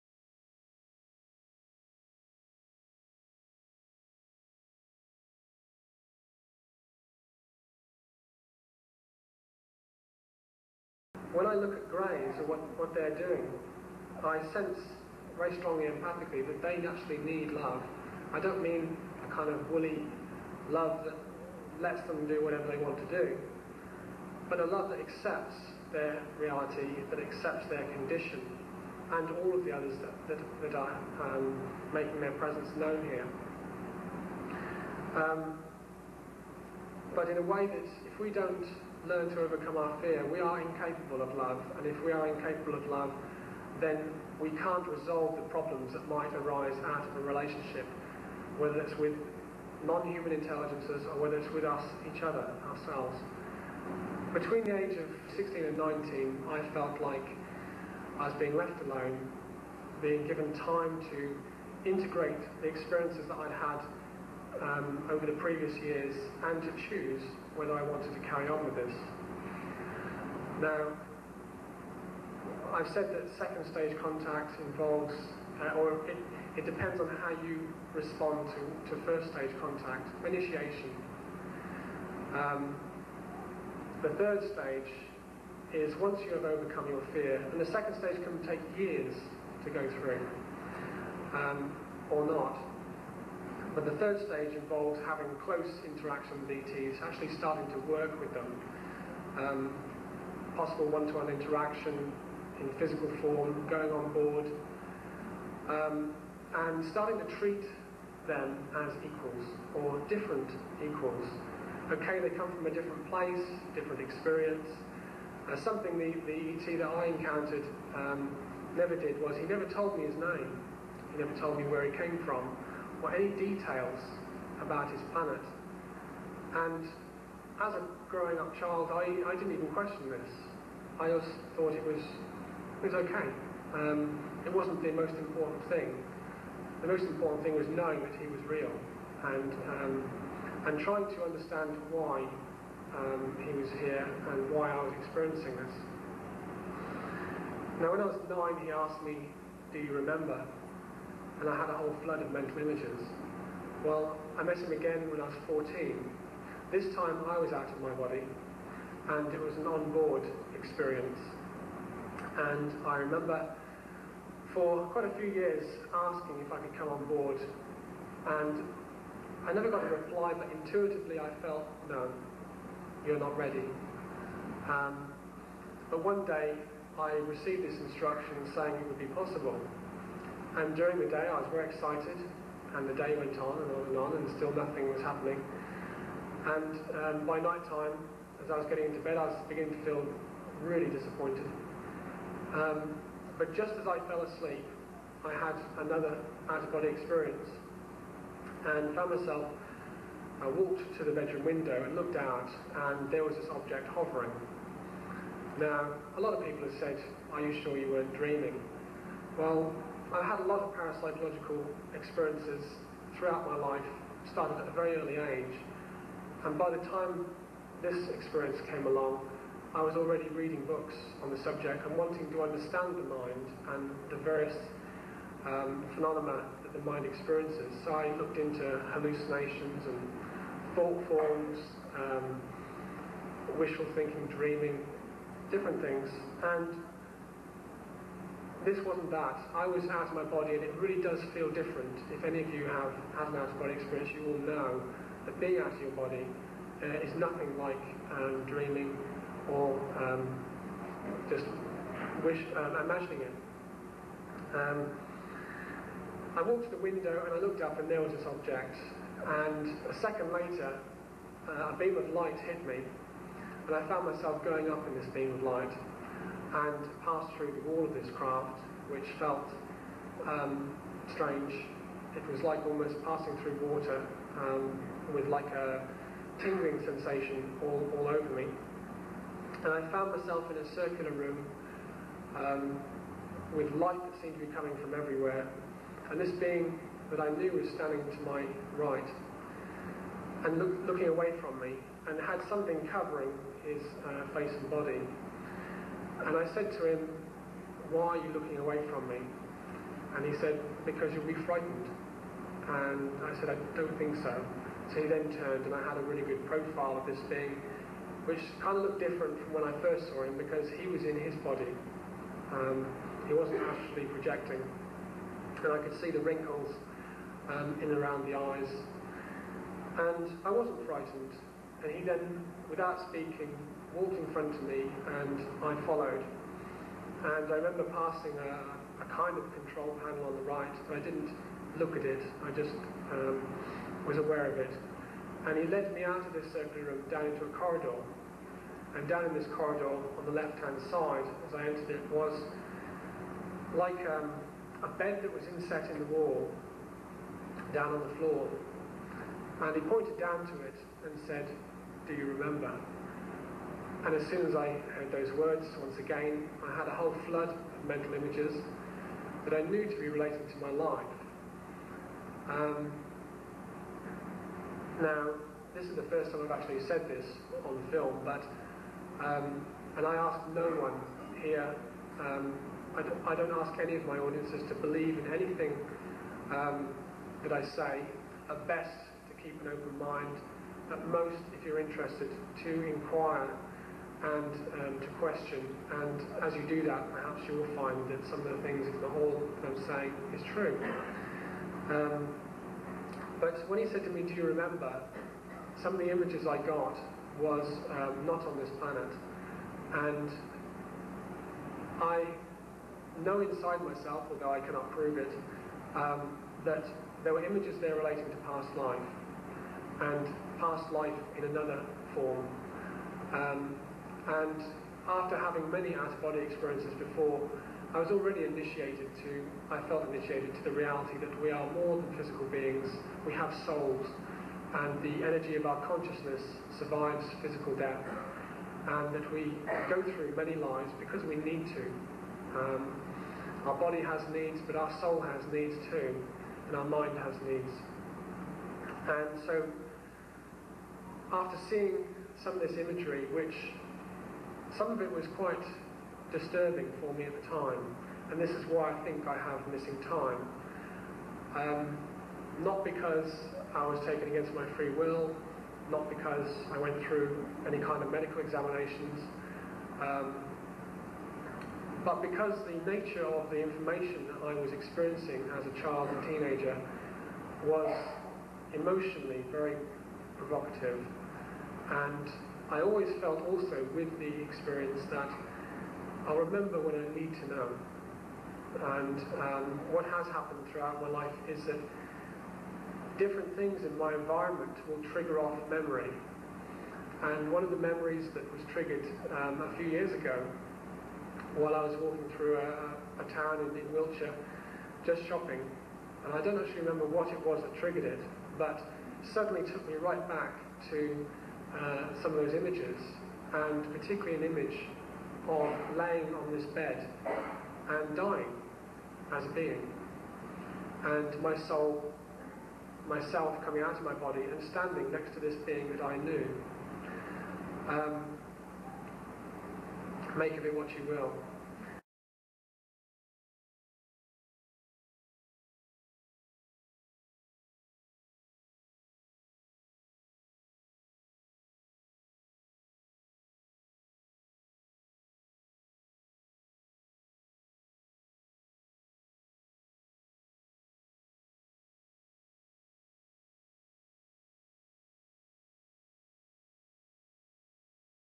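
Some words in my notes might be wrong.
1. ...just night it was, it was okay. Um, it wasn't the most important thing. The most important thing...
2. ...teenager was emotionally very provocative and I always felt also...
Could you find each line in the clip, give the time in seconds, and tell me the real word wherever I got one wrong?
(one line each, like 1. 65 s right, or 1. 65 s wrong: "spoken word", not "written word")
1. 131 s wrong: "thought", not "night"
2. 466 s right.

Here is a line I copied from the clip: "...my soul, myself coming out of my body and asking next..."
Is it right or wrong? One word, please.
wrong.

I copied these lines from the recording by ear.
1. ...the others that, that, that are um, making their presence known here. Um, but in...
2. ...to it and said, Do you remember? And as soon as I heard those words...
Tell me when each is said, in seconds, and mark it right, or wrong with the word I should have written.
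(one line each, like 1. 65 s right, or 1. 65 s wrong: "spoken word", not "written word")
1. 29 s right
2. 350 s right.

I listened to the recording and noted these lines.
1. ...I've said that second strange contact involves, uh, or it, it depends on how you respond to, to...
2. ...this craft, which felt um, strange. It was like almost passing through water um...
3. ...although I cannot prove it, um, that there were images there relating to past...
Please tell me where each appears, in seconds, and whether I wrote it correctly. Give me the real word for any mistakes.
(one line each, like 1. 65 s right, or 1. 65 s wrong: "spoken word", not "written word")
1. 72 s wrong: "stage", not "strange"
2. 267 s right
3. 404 s right.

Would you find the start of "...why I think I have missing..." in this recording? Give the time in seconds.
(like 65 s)
448 s.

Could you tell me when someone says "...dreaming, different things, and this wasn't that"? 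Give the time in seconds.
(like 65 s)
234 s.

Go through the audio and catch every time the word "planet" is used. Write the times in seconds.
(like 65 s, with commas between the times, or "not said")
125 s, 398 s.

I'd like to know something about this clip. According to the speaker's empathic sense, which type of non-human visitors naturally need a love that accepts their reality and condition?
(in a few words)
Greys.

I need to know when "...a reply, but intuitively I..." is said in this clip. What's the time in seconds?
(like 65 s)
169 s.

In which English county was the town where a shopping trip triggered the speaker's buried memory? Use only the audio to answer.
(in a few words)
Wiltshire.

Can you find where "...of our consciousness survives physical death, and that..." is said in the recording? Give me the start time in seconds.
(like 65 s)
425 s.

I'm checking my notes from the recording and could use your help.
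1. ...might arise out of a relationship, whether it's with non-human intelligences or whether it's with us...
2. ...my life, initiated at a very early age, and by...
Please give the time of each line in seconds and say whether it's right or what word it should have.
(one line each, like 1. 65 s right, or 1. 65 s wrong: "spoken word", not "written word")
1. 46 s right
2. 213 s wrong: "started", not "initiated".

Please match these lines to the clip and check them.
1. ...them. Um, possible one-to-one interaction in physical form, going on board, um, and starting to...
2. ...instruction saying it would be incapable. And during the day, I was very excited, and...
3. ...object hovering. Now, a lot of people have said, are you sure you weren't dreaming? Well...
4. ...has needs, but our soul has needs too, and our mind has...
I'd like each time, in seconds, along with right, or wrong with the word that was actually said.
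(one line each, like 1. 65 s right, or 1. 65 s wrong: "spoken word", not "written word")
1. 98 s right
2. 177 s wrong: "possible", not "incapable"
3. 203 s right
4. 434 s right.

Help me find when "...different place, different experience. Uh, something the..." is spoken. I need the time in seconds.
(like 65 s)
112 s.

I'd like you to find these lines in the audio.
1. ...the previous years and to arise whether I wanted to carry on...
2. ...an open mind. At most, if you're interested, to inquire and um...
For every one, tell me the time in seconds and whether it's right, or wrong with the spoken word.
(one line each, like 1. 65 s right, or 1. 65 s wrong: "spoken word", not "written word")
1. 65 s wrong: "choose", not "arise"
2. 379 s right.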